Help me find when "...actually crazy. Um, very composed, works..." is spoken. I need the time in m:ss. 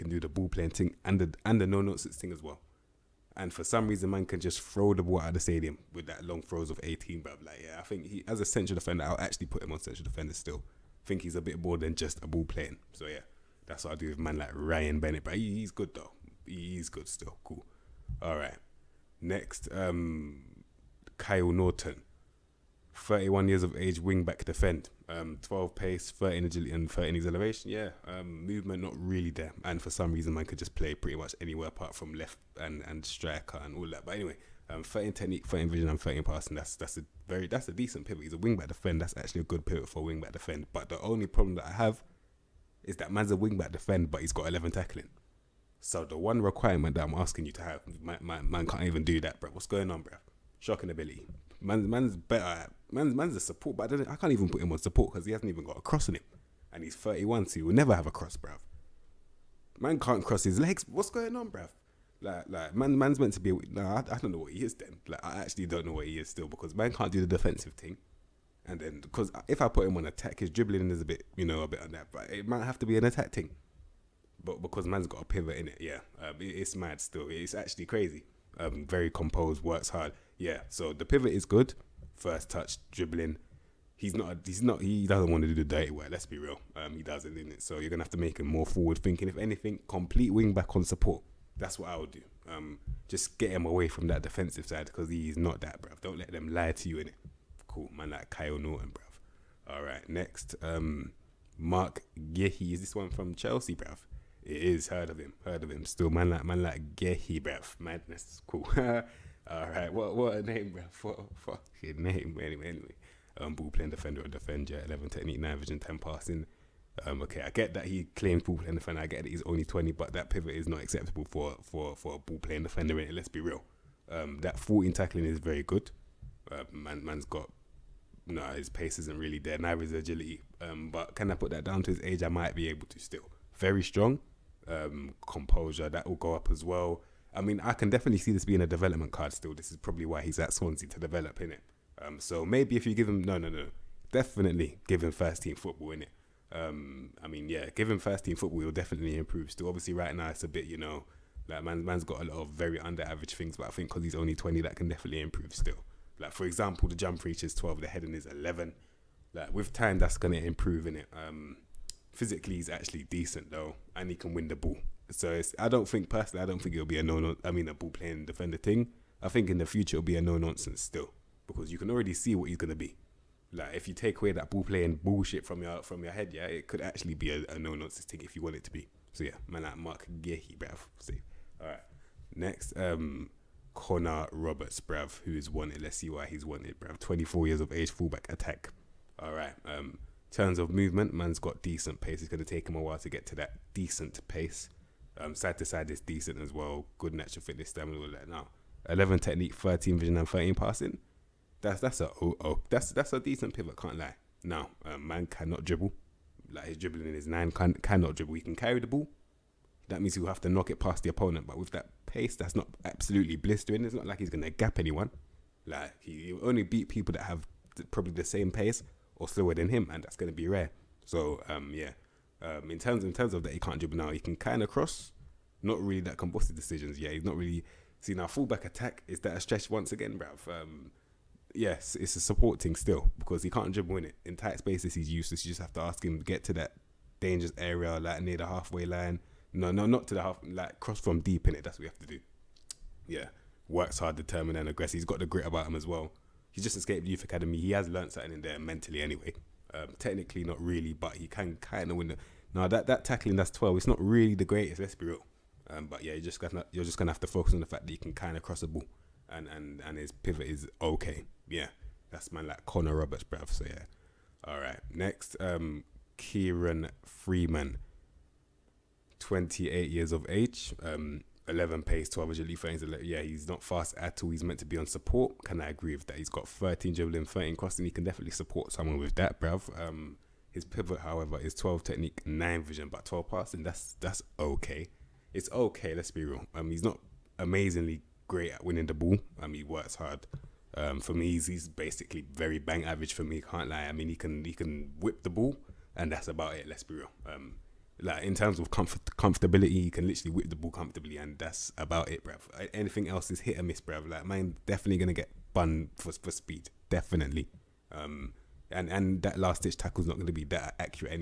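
1:17.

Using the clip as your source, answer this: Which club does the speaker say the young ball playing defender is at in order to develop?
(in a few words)
Swansea.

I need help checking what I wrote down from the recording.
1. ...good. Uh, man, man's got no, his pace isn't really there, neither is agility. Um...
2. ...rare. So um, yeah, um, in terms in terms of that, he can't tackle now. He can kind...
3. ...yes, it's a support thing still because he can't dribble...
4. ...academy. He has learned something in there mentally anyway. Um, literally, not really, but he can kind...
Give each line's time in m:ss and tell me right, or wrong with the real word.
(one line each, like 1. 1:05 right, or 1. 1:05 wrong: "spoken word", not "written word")
1. 2:05 right
2. 3:40 wrong: "dribble", not "tackle"
3. 3:51 right
4. 4:07 wrong: "technically", not "literally".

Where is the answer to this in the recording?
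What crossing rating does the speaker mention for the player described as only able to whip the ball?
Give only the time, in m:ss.
4:37.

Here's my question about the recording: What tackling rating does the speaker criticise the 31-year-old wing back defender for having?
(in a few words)
11.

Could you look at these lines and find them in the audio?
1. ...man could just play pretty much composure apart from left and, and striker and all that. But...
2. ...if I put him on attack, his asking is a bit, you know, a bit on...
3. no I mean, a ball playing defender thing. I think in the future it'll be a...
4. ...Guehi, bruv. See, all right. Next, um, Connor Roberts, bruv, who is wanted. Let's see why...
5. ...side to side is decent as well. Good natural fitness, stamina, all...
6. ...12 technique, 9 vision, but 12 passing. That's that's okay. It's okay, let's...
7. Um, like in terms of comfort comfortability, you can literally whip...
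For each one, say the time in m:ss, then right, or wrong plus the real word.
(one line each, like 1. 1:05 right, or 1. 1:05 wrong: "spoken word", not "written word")
1. 0:30 wrong: "anywhere", not "composure"
2. 1:09 wrong: "dribbling", not "asking"
3. 2:47 right
4. 3:00 right
5. 3:15 right
6. 4:41 right
7. 4:57 right.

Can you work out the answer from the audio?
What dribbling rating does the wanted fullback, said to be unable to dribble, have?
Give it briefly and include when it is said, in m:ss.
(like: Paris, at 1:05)
9, at 3:26.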